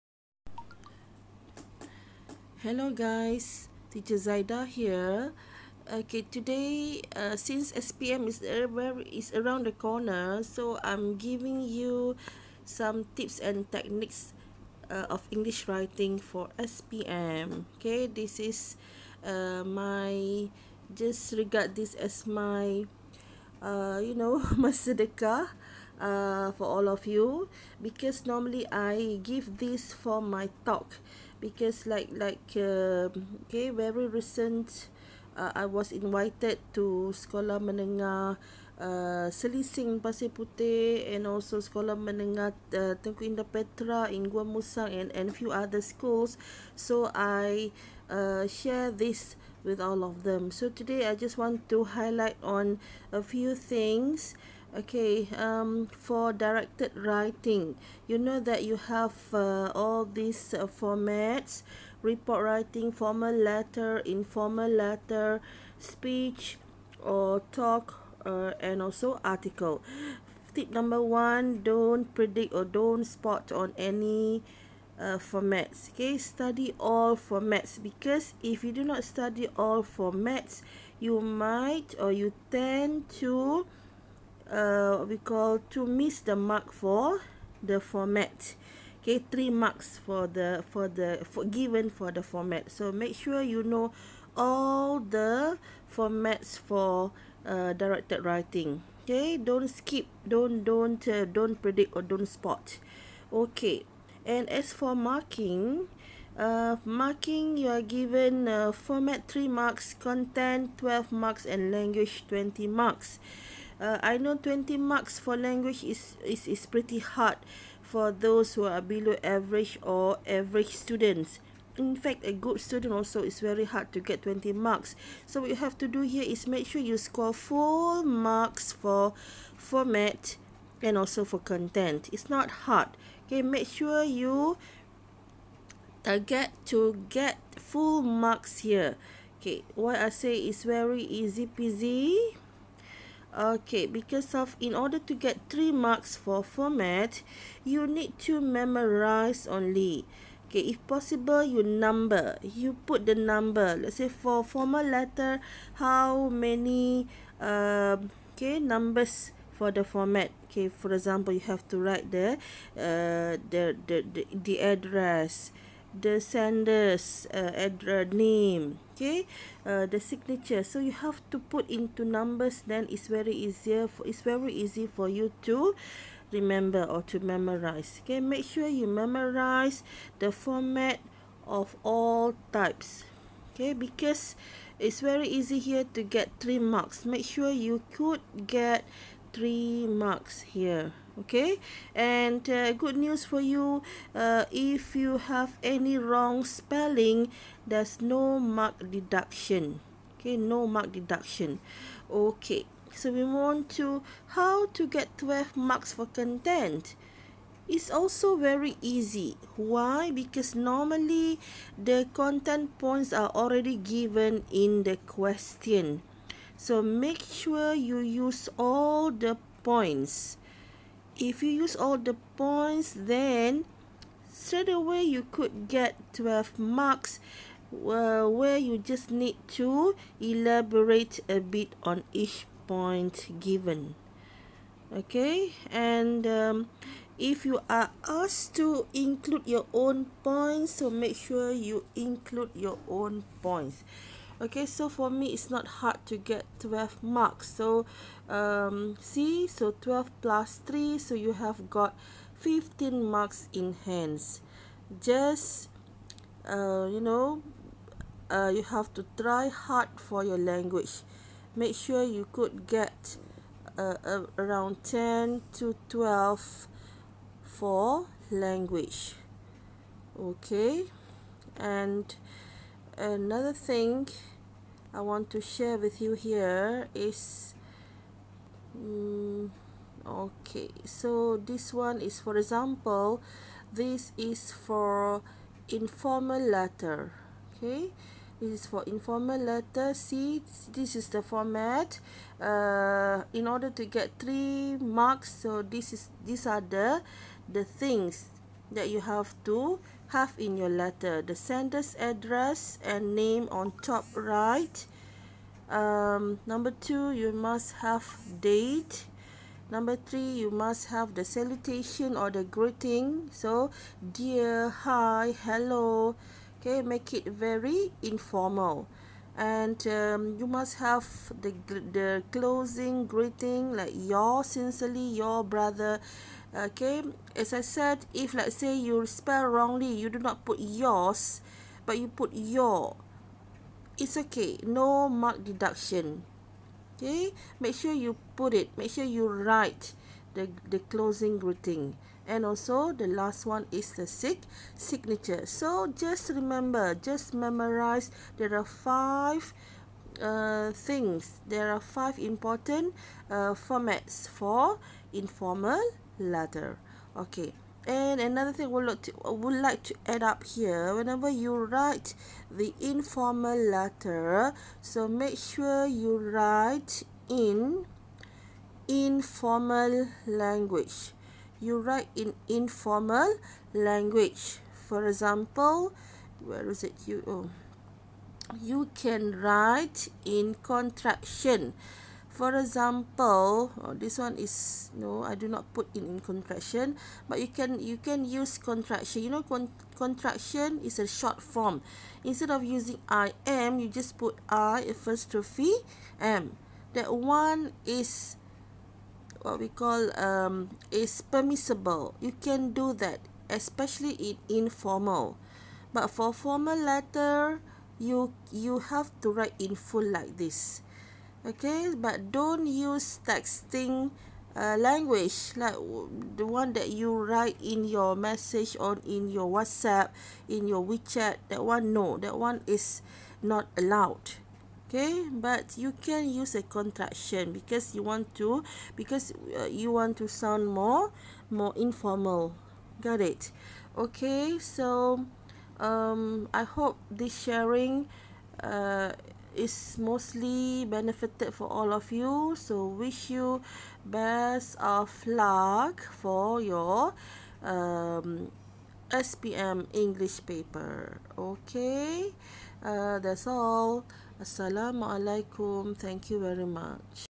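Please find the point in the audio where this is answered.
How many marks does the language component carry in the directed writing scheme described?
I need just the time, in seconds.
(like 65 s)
111 s.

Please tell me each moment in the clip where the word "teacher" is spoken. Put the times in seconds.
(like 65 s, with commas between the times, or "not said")
3 s.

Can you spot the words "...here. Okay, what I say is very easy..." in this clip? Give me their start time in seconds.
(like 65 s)
138 s.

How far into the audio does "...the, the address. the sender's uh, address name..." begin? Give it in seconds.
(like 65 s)
164 s.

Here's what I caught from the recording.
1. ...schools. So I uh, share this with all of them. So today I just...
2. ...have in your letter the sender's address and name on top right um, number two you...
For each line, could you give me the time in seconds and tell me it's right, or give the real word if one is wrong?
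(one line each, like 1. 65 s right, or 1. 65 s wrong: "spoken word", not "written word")
1. 45 s right
2. 300 s right.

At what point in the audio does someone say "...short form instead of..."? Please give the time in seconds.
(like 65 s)
391 s.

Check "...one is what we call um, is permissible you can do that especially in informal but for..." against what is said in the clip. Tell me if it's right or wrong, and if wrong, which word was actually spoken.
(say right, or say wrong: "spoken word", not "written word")
right.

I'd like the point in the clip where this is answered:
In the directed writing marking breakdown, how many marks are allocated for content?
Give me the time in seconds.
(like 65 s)
109 s.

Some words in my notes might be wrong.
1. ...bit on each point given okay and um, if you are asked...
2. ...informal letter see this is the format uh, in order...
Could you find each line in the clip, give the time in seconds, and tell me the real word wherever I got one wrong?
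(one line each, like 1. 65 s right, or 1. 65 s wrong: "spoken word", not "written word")
1. 231 s right
2. 288 s right.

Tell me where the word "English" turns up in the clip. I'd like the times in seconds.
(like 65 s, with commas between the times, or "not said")
15 s, 449 s.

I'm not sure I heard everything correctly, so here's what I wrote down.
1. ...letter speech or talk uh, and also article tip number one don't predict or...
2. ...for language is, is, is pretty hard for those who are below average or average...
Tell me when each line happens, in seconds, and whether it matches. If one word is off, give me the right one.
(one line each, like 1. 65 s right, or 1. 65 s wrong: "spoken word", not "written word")
1. 64 s right
2. 115 s right.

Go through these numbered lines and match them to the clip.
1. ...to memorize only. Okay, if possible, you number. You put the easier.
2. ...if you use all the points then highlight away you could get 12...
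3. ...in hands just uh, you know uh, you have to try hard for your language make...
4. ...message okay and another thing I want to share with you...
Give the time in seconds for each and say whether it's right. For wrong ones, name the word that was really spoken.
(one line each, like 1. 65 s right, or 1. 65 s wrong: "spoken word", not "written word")
1. 148 s wrong: "number", not "easier"
2. 221 s wrong: "straight", not "highlight"
3. 253 s right
4. 268 s wrong: "language", not "message".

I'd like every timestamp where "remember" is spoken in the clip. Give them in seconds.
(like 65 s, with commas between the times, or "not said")
176 s, 346 s.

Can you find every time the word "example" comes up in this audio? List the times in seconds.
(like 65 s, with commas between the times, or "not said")
160 s, 282 s, 375 s, 382 s.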